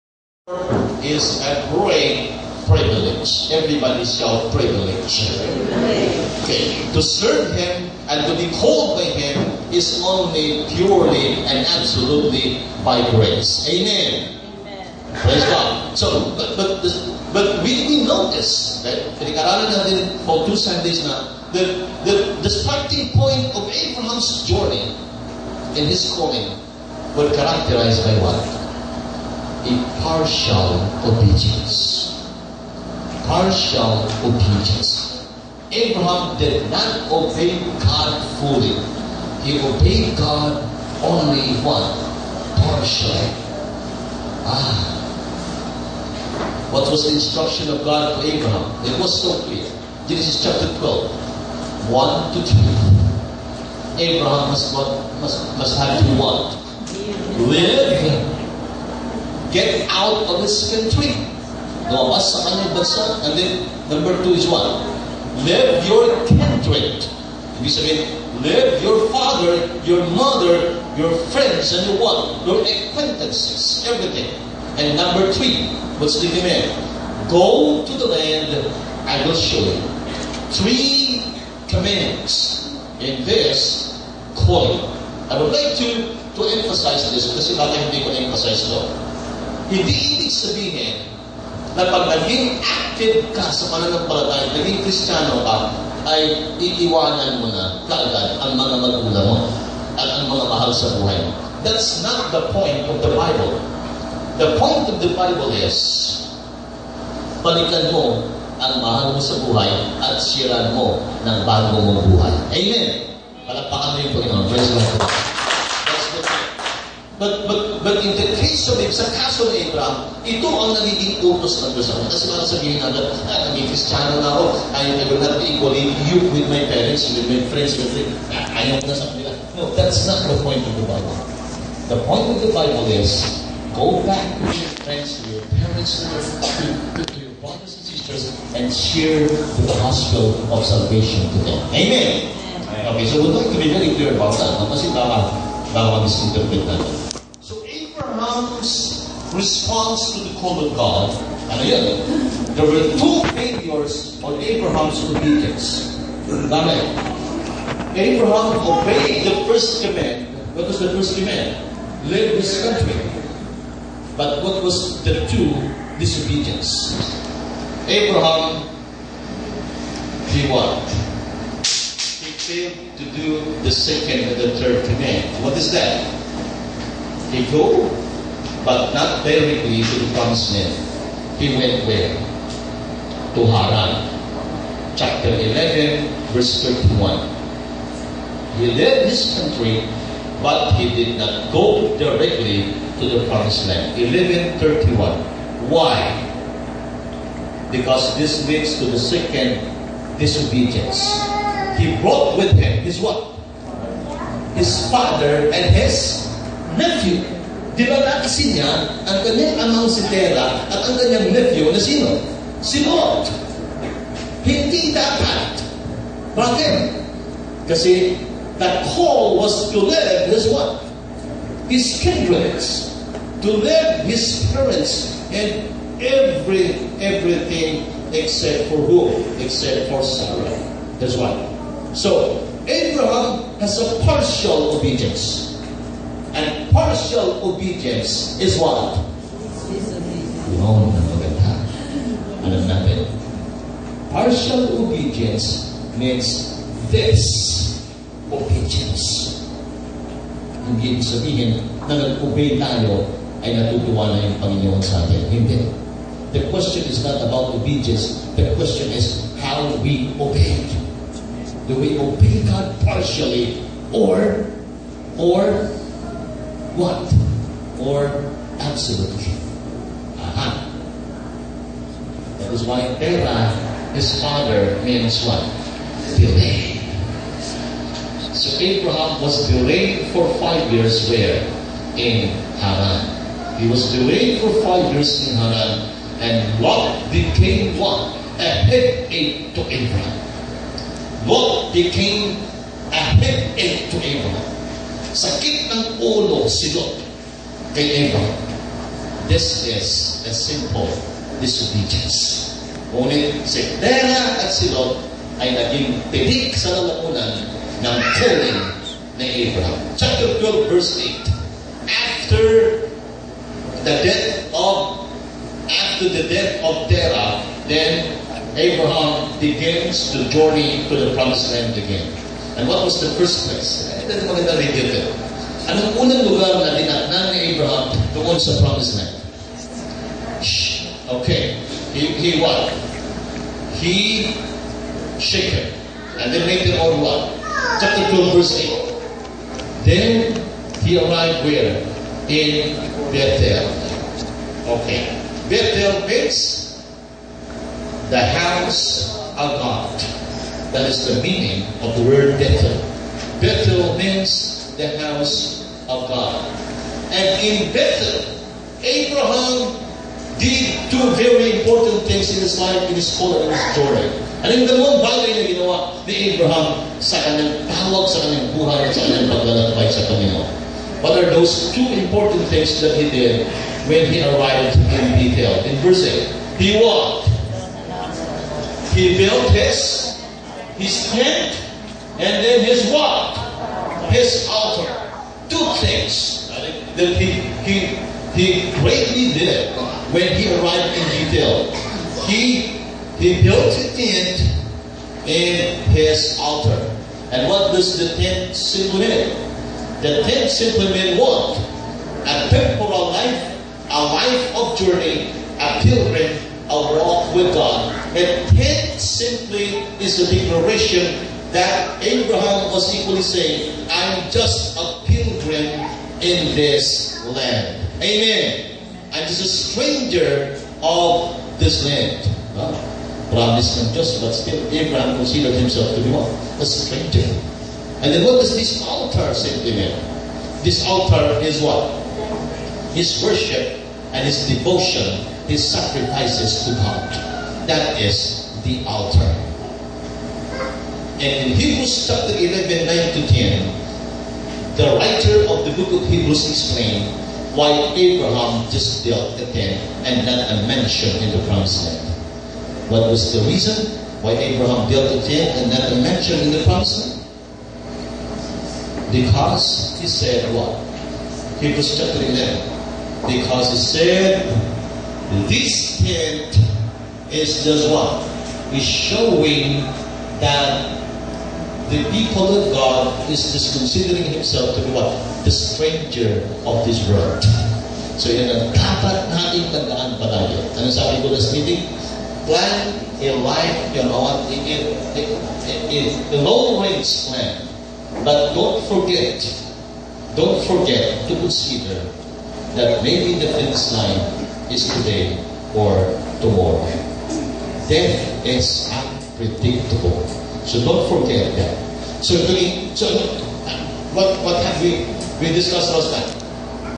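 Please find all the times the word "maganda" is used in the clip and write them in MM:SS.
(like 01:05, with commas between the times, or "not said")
04:01, 05:24.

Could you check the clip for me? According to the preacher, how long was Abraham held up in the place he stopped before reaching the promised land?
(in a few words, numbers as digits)
5 years.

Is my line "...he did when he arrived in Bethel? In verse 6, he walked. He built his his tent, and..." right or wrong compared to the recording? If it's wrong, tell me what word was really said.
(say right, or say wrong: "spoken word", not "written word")
wrong: "8", not "6".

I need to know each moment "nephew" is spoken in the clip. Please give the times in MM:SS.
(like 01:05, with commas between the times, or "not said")
03:26, 03:31.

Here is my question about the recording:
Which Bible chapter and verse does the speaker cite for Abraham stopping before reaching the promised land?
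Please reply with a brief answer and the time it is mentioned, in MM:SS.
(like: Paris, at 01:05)
Chapter 11, verse 31, at 03:04.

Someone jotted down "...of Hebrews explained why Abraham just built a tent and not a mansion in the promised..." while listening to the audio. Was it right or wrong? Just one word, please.
right.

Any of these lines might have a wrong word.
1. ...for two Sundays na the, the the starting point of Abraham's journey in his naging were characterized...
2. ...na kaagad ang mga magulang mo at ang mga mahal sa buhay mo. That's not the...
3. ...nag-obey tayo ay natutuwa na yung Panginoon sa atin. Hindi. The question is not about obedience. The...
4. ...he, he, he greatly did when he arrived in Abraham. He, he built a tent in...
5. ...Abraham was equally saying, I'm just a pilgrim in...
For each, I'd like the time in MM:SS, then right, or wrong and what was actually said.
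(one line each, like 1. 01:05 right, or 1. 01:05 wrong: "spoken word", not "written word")
1. 00:20 wrong: "calling", not "naging"
2. 01:37 right
3. 04:11 right
4. 06:27 wrong: "Gibeon", not "Abraham"
5. 06:52 right.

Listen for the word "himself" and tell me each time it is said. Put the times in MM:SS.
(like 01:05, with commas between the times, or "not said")
07:05, 07:54.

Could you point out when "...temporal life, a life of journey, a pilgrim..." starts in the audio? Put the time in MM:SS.
06:42.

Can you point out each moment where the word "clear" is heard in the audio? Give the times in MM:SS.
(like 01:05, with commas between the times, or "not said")
00:49, 02:23.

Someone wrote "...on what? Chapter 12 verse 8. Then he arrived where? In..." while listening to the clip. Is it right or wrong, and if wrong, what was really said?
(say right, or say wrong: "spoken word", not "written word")
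right.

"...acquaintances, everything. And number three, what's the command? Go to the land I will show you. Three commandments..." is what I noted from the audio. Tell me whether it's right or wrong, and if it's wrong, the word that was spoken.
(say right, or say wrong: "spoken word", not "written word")
right.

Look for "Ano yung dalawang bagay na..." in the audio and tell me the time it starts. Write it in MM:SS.
06:04.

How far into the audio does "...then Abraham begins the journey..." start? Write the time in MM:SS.
05:17.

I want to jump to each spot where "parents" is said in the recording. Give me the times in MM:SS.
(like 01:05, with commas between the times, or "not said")
02:06, 02:15, 03:44.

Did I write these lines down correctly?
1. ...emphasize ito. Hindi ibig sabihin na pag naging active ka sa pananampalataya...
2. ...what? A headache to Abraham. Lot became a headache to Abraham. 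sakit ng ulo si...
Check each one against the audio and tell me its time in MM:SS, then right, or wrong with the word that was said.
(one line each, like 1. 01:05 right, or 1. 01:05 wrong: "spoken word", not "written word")
1. 01:28 right
2. 04:47 right.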